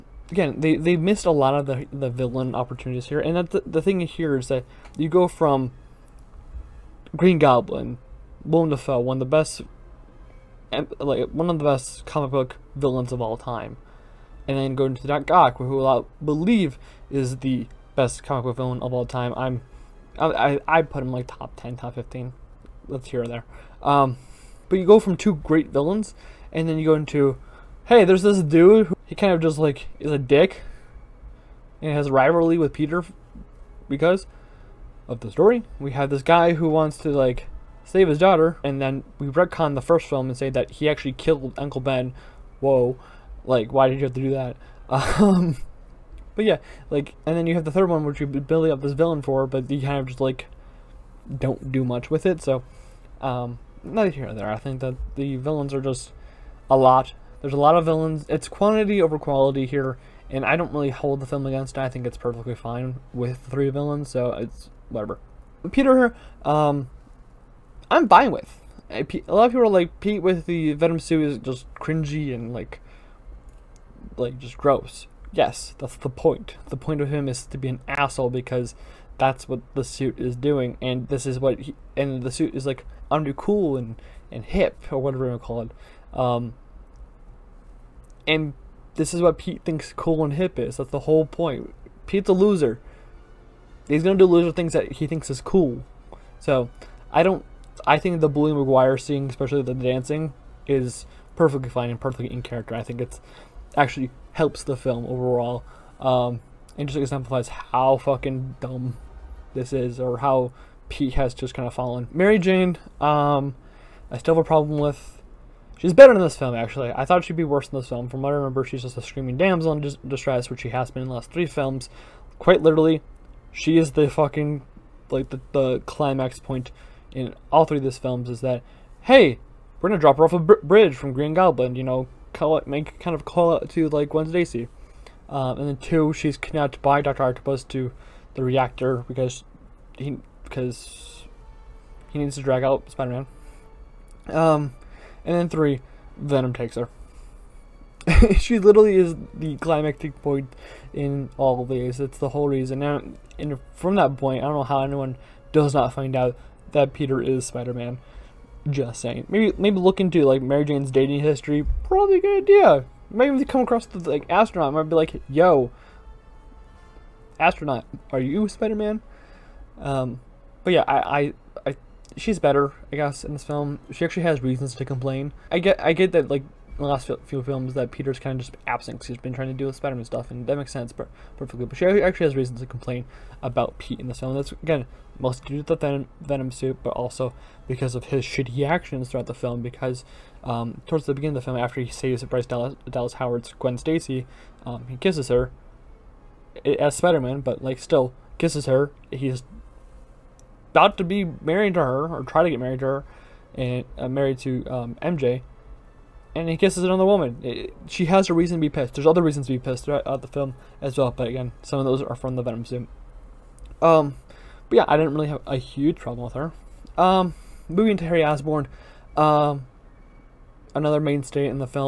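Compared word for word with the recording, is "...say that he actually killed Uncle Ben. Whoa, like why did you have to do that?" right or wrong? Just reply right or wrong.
right.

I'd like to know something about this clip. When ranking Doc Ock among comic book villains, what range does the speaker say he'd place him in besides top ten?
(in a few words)
top 15.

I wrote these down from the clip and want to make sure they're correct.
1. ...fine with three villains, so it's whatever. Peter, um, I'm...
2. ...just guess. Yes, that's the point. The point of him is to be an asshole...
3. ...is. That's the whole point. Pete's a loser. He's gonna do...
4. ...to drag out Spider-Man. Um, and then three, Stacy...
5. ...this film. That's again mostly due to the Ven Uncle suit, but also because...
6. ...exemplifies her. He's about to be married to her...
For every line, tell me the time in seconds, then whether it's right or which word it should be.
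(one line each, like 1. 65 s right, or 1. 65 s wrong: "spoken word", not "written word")
1. 62 s right
2. 74 s wrong: "gross", not "guess"
3. 90 s right
4. 142 s wrong: "Venom", not "Stacy"
5. 184 s wrong: "Venom", not "Uncle"
6. 198 s wrong: "kisses", not "exemplifies".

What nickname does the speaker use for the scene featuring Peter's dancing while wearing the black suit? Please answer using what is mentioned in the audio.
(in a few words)
Bully Maguire.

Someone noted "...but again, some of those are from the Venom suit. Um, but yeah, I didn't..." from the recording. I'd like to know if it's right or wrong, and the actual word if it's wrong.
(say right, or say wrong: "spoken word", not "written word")
right.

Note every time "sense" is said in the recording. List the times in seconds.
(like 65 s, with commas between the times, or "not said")
180 s.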